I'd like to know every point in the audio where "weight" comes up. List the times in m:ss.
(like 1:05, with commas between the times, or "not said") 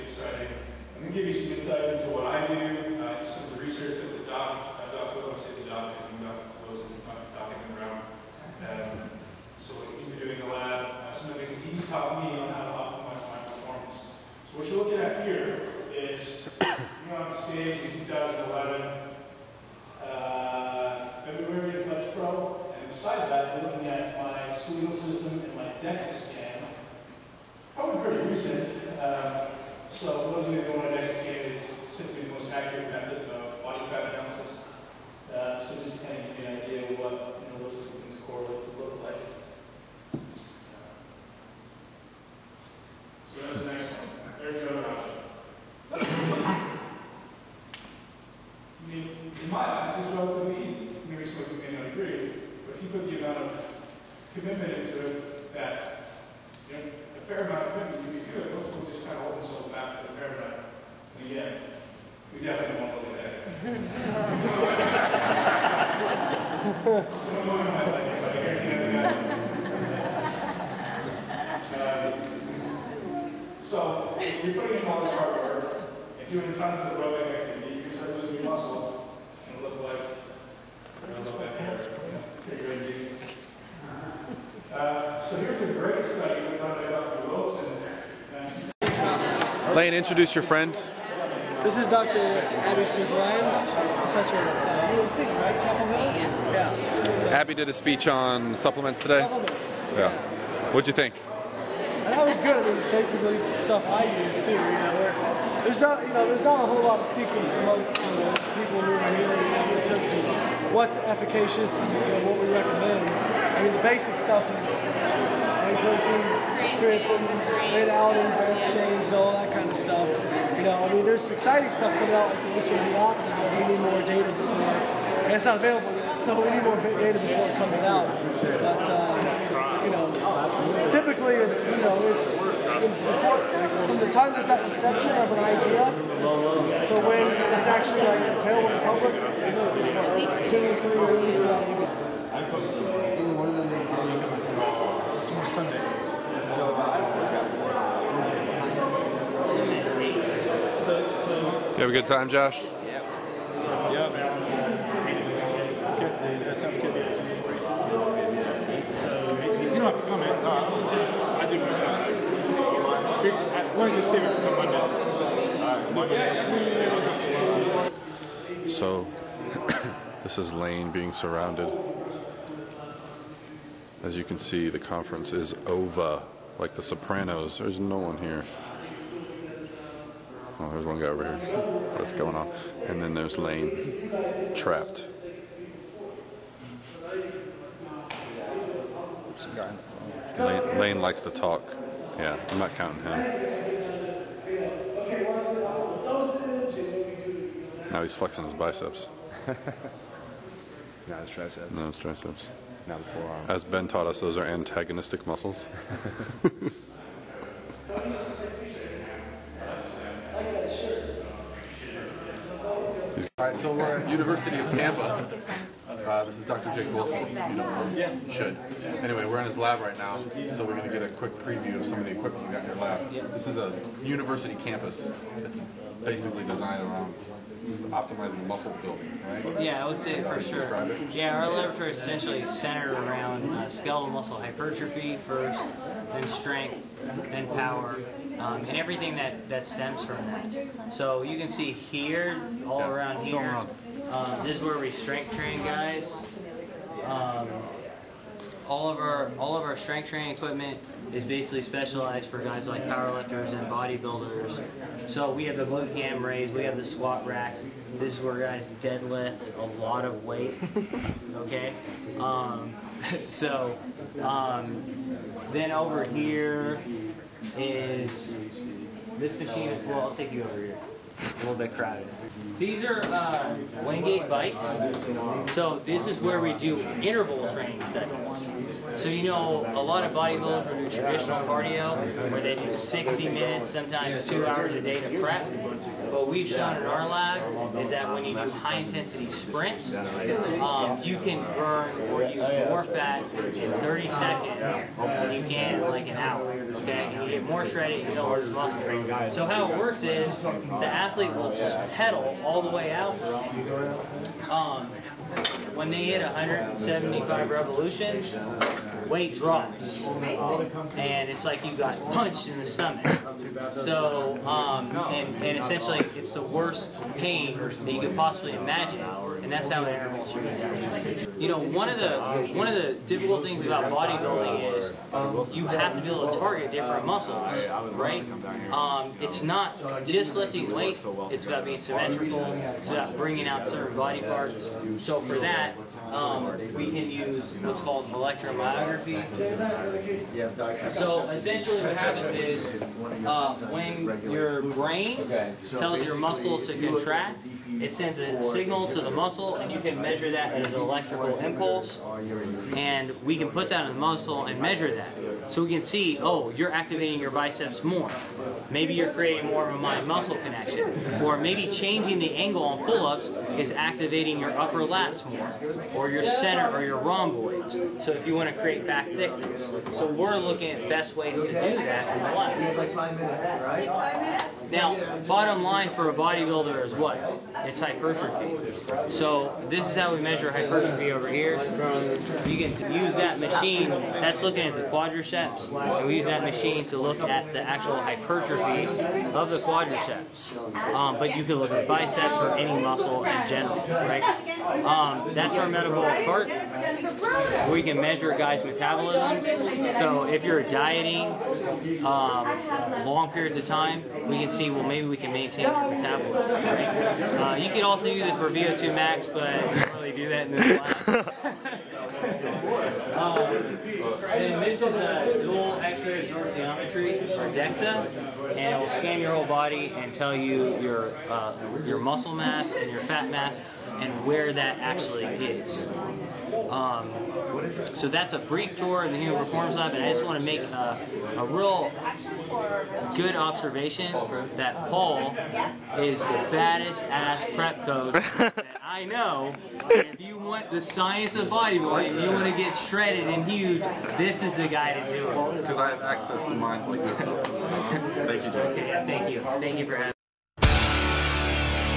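1:57, 4:20, 5:09, 5:30.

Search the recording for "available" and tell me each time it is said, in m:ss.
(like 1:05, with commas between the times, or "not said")
2:05, 2:18.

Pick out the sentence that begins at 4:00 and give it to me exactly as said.
So you can see here, all around here, um, this is where we strength train guys.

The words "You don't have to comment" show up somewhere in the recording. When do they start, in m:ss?
2:36.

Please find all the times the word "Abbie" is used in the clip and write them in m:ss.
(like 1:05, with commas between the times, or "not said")
1:32, 1:37.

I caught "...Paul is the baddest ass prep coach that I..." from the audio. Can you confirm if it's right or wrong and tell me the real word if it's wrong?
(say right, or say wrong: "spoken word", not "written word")
right.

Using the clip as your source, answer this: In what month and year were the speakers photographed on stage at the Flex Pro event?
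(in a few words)
February 2011.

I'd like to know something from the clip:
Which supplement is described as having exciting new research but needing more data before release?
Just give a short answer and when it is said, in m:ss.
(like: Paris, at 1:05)
HMB, at 2:02.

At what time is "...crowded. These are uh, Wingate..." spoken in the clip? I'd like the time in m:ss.
4:31.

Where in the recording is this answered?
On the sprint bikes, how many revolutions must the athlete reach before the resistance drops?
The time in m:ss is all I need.
5:06.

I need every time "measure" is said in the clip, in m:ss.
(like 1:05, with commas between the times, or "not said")
5:50, 5:54, 6:20, 6:38.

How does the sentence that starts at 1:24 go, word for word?
Uh, so here's a great study done by Dr.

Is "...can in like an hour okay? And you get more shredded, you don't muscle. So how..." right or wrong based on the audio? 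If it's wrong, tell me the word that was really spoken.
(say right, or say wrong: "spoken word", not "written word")
right.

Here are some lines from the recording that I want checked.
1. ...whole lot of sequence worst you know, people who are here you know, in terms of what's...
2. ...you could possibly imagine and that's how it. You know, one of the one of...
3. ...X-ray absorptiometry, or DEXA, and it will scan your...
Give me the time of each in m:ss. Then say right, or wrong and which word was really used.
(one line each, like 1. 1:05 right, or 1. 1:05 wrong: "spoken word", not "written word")
1. 1:46 wrong: "amongst", not "worst"
2. 5:17 right
3. 6:55 right.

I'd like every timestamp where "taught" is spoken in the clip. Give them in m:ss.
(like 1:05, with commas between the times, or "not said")
0:11, 3:23.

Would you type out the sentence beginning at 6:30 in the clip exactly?
Um, but you can look at biceps or any muscle in general, right?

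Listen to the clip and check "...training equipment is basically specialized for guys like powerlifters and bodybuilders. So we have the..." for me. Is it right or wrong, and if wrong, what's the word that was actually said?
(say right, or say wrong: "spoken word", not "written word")
right.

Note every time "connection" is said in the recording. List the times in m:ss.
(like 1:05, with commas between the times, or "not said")
6:00.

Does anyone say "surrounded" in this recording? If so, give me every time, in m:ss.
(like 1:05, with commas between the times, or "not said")
2:51.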